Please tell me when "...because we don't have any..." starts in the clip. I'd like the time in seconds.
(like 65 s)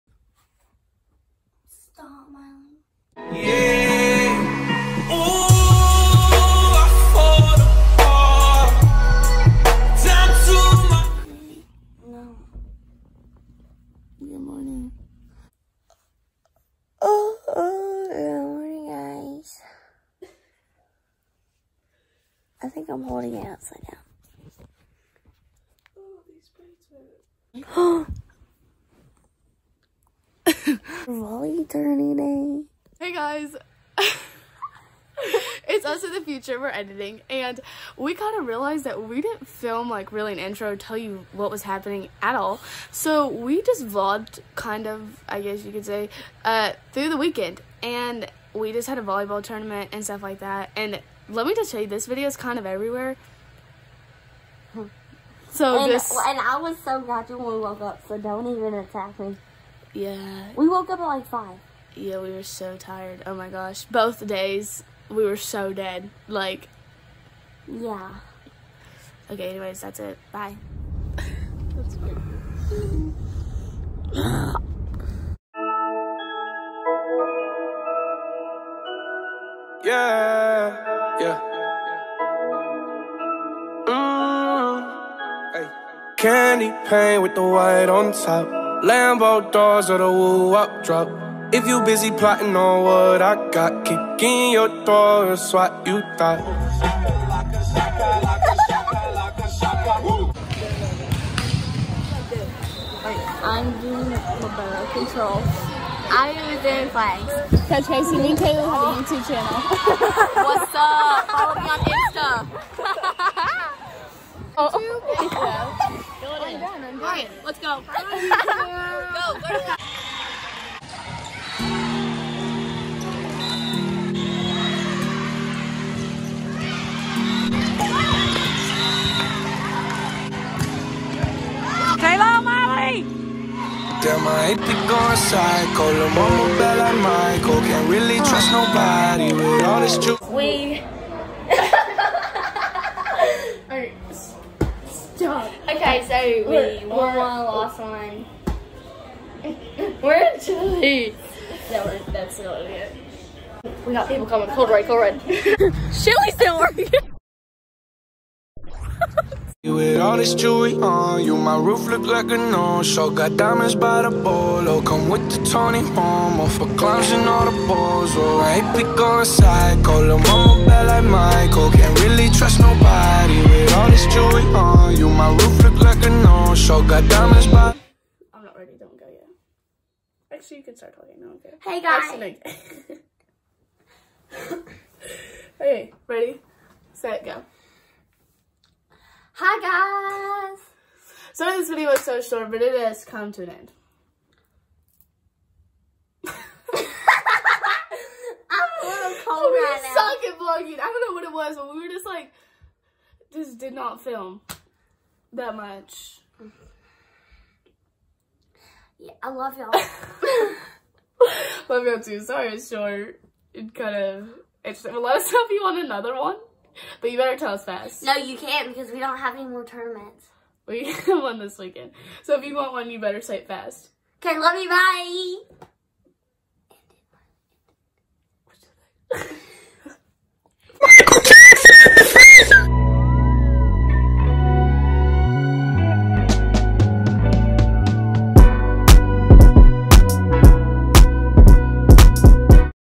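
218 s.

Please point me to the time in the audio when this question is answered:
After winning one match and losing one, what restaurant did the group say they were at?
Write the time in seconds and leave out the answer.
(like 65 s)
150 s.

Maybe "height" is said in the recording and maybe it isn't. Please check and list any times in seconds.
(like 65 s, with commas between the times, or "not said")
not said.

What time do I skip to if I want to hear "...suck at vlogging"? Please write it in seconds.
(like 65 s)
199 s.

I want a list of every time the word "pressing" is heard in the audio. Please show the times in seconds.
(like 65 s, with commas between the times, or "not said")
not said.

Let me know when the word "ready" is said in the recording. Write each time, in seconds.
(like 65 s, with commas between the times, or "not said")
178 s, 186 s.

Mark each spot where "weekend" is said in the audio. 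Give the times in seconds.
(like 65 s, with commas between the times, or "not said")
47 s, 221 s.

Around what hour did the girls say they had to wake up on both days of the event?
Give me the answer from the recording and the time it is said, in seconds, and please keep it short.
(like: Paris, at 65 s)
5, at 61 s.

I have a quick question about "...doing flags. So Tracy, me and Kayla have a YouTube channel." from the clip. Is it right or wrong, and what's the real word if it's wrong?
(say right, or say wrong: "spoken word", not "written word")
right.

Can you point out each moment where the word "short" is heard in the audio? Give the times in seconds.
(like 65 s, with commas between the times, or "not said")
192 s, 212 s.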